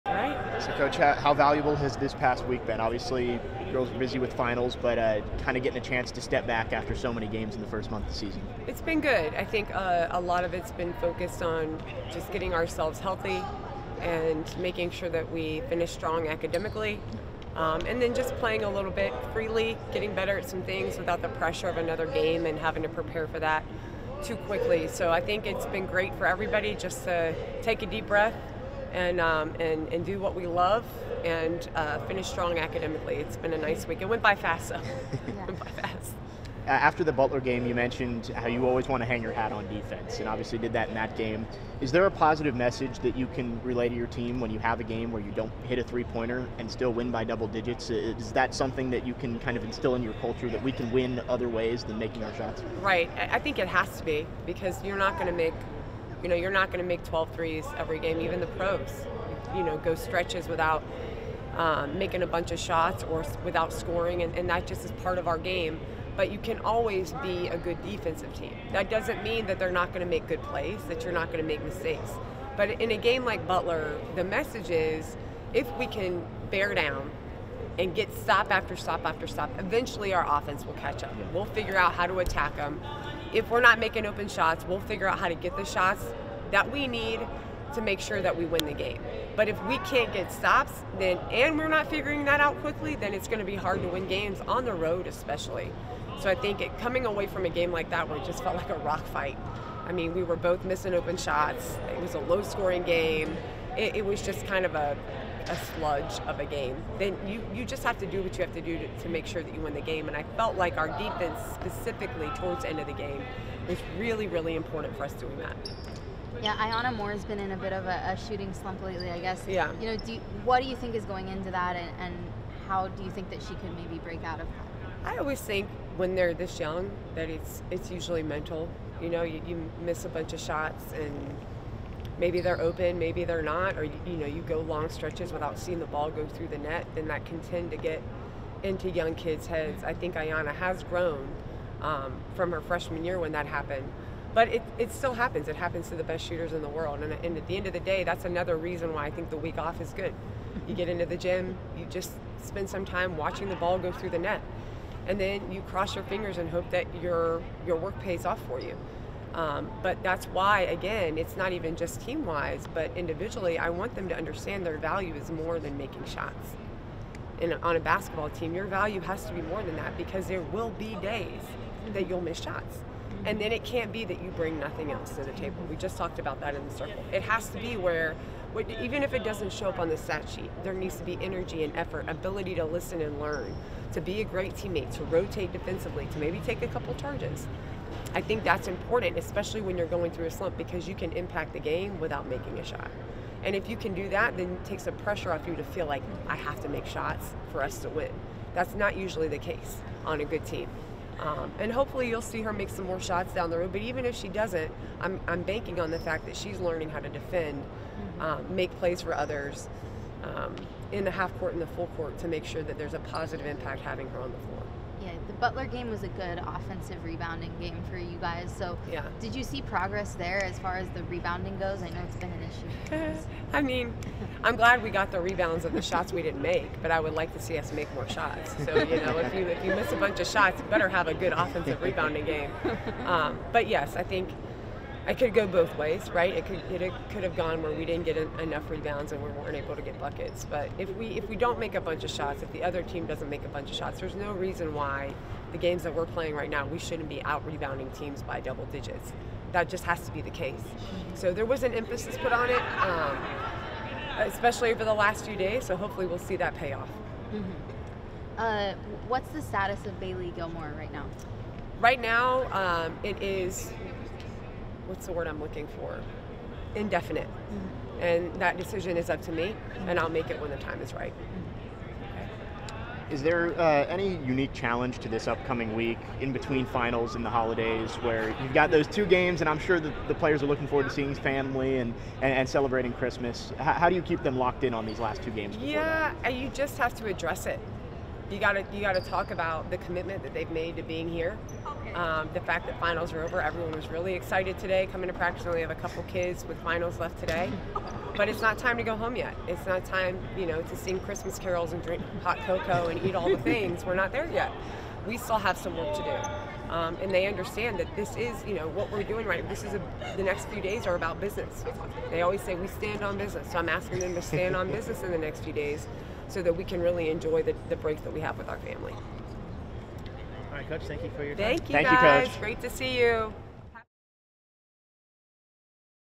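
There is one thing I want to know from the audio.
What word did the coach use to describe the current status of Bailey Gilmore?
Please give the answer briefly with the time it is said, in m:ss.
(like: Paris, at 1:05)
Indefinite, at 4:26.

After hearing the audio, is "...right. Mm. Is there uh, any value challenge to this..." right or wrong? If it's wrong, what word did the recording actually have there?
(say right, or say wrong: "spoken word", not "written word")
wrong: "unique", not "value".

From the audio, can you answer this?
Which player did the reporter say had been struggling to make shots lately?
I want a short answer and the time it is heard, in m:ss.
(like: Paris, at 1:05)
Iyana Moore, at 1:56.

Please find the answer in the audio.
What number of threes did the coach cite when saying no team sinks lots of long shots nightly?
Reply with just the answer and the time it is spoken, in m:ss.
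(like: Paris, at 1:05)
12, at 0:57.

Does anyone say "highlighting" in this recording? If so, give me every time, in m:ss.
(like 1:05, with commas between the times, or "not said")
not said.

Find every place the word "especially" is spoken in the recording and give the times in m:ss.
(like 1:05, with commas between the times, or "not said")
1:35, 3:09, 4:14.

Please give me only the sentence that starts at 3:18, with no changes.
That's not usually the case on a good team.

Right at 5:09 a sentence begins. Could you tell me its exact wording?
This is a, the next few days are about business.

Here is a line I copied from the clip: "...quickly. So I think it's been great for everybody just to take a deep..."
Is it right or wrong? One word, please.
right.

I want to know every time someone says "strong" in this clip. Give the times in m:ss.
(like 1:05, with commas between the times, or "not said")
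0:15, 0:32.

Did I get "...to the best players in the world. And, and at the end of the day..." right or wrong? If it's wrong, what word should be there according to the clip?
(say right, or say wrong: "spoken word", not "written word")
wrong: "shooters", not "players".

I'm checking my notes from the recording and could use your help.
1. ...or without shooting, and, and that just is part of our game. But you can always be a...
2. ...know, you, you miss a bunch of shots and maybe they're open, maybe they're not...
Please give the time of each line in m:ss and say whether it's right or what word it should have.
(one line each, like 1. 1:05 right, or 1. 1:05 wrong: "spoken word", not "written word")
1. 1:03 wrong: "scoring", not "shooting"
2. 2:09 right.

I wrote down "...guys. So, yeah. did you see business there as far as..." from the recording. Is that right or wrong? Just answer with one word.
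wrong.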